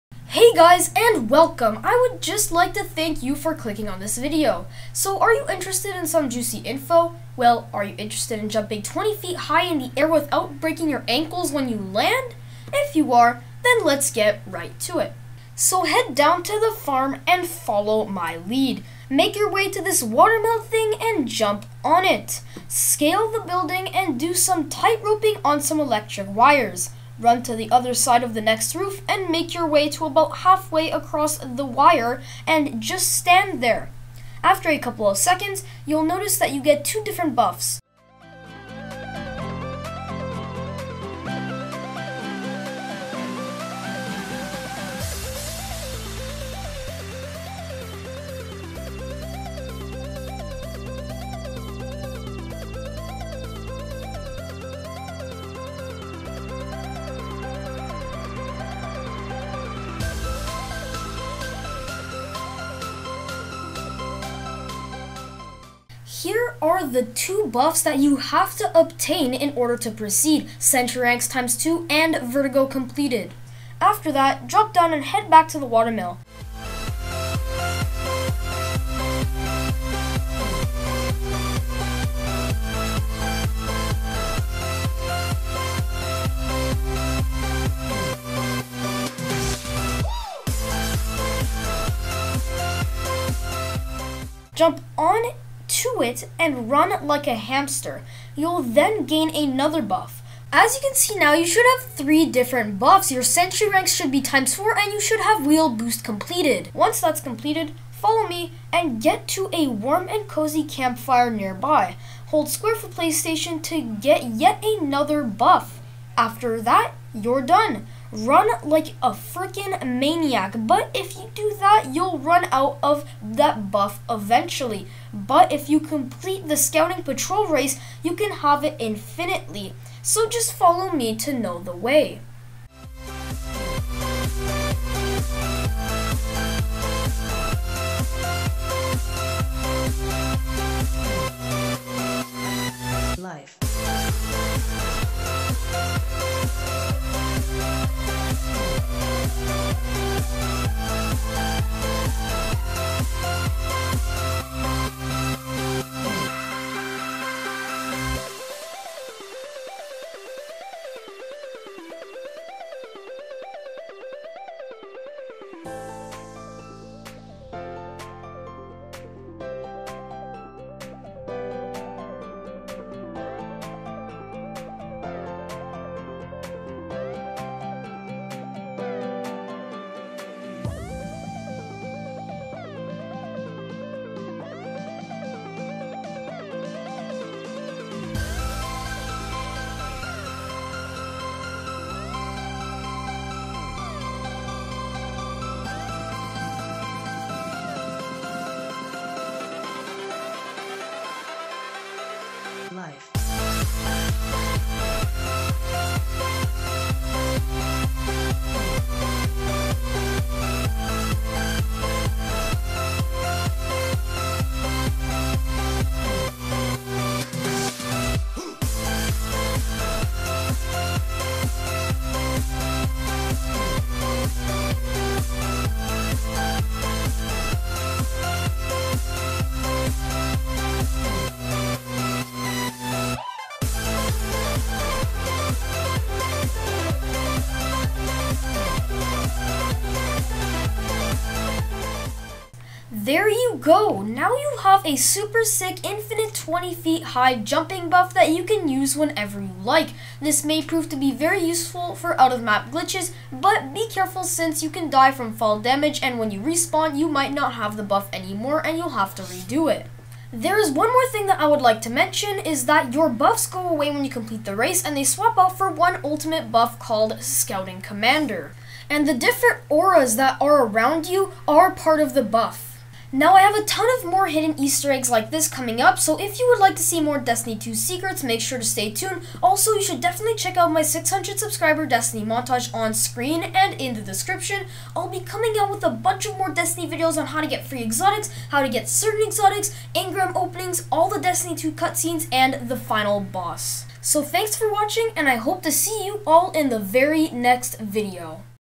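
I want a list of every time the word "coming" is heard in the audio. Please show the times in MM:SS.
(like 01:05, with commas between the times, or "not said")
04:35, 04:45.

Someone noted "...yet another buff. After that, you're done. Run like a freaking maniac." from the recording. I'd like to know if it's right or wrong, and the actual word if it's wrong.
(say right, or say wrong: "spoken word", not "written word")
right.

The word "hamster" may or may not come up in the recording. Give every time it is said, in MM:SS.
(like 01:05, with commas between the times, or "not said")
01:37.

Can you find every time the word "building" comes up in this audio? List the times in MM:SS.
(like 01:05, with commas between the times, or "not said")
00:23.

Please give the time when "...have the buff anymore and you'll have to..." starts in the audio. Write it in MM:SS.
04:17.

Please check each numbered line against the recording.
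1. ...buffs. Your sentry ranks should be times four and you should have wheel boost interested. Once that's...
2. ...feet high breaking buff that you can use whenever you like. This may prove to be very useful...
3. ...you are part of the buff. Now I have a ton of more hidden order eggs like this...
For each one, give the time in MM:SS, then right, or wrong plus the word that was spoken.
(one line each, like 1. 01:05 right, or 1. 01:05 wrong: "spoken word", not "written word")
1. 01:42 wrong: "completed", not "interested"
2. 04:06 wrong: "jumping", not "breaking"
3. 04:31 wrong: "easter", not "order".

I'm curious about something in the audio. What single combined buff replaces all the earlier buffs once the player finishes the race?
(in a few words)
Scouting Commander.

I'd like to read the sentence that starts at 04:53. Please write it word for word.
So thanks for watching, and I hope to see you all in the very next video.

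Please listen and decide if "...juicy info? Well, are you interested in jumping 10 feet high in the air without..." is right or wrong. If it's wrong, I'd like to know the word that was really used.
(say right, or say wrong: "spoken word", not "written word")
wrong: "20", not "10".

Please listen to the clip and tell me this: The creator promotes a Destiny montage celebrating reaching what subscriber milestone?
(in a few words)
600.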